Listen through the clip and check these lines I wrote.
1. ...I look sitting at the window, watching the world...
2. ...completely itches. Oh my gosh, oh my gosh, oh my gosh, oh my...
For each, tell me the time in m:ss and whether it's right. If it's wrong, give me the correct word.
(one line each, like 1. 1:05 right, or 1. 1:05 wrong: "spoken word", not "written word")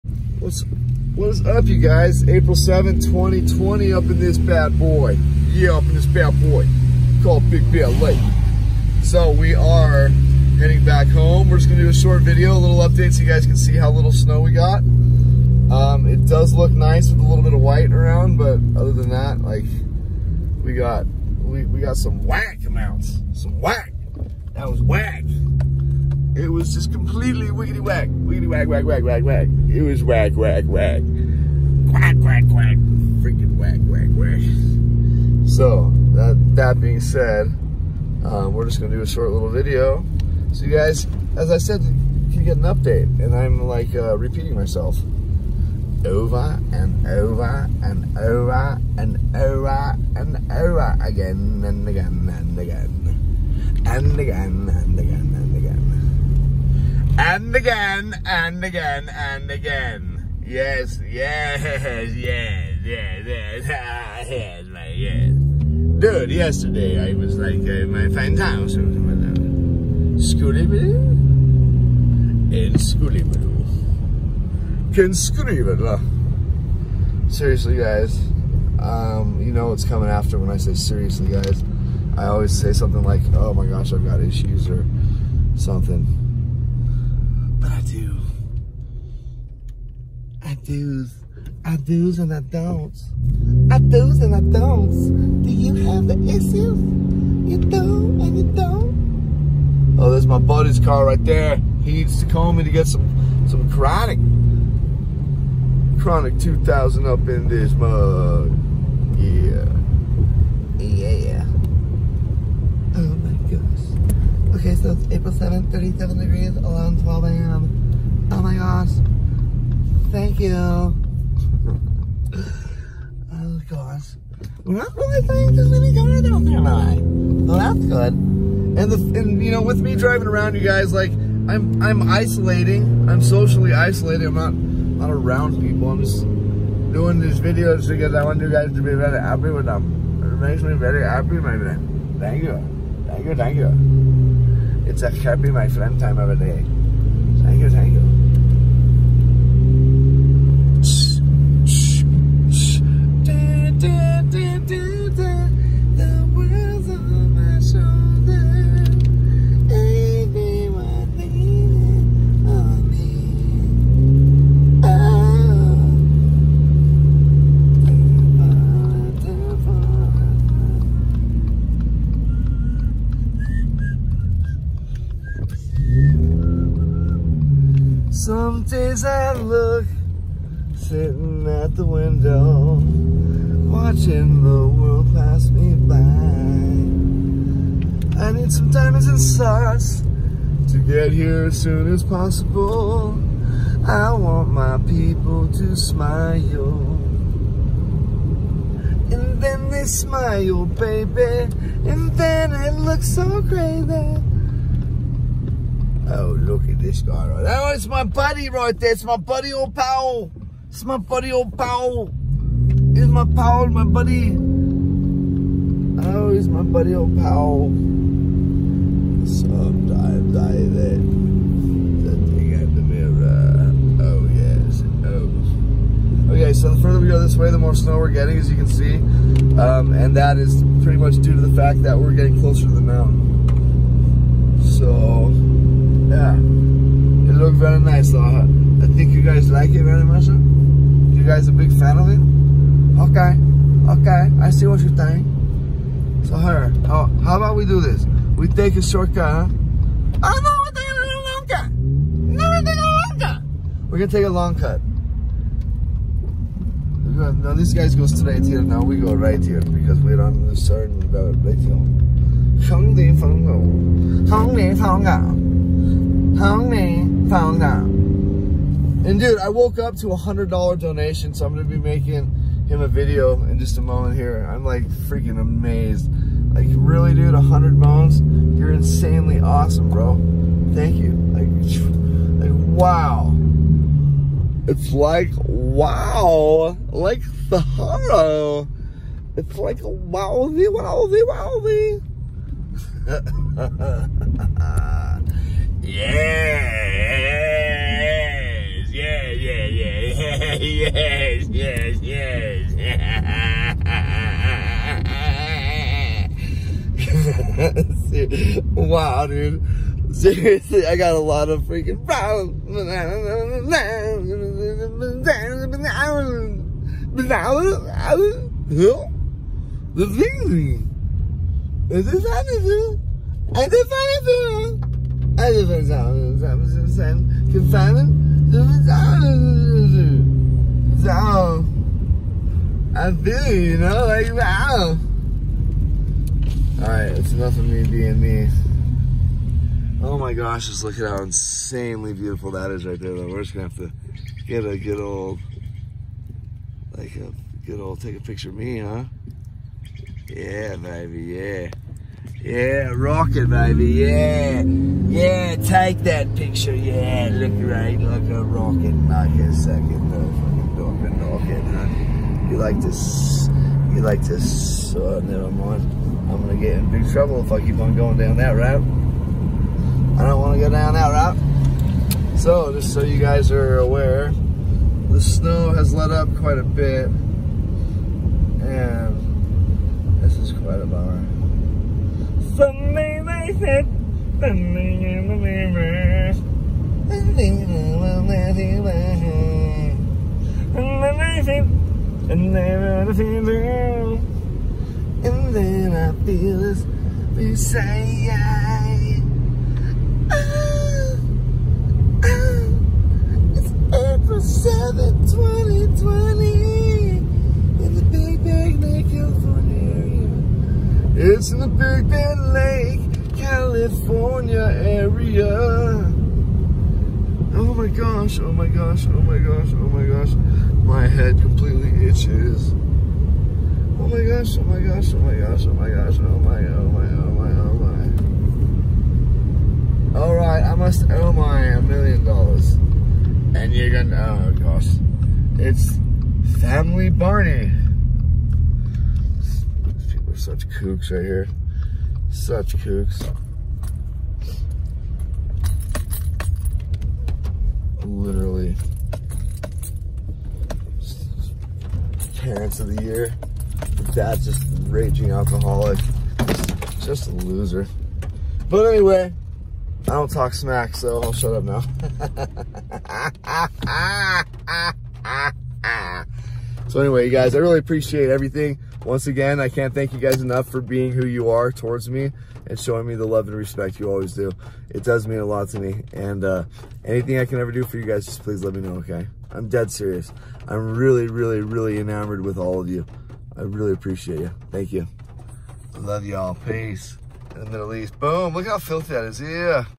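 1. 2:59 right
2. 7:01 right.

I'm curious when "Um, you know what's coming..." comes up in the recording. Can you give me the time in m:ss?
1:18.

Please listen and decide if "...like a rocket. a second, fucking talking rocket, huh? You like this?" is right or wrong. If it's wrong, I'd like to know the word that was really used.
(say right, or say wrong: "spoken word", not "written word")
right.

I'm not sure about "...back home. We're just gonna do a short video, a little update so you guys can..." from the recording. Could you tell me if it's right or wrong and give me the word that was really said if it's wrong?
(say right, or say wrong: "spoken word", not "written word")
right.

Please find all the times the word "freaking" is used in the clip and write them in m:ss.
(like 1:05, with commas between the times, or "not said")
0:33, 4:34, 5:11.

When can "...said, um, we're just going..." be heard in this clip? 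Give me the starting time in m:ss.
0:37.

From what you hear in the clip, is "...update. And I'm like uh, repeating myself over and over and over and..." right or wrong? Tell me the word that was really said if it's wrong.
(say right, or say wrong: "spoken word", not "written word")
right.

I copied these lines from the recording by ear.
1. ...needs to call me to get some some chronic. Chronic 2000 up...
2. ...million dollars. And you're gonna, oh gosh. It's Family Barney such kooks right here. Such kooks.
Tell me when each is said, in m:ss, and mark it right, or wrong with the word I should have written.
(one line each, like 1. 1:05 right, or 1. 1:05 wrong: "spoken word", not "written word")
1. 1:41 right
2. 7:11 right.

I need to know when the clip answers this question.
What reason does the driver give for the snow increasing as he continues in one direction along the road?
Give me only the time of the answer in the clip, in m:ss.
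3:52.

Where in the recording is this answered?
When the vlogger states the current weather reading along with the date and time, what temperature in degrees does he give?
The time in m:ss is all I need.
1:55.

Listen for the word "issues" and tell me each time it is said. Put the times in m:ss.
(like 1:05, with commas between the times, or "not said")
1:24, 1:36.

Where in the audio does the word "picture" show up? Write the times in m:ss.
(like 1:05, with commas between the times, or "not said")
5:48, 5:56.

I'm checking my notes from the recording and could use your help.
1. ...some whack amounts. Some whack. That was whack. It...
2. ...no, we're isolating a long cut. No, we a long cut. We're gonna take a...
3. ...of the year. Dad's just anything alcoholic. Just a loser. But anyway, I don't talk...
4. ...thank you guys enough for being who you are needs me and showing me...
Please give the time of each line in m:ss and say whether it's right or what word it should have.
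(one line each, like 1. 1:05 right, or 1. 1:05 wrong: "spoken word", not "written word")
1. 0:21 right
2. 4:10 wrong: "taking", not "isolating"
3. 7:32 wrong: "raging", not "anything"
4. 7:49 wrong: "towards", not "needs".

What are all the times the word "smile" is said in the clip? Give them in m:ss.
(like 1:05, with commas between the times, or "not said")
3:15, 3:19.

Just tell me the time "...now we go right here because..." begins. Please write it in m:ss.
4:18.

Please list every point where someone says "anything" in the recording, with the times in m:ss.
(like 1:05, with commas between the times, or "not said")
5:22, 7:57.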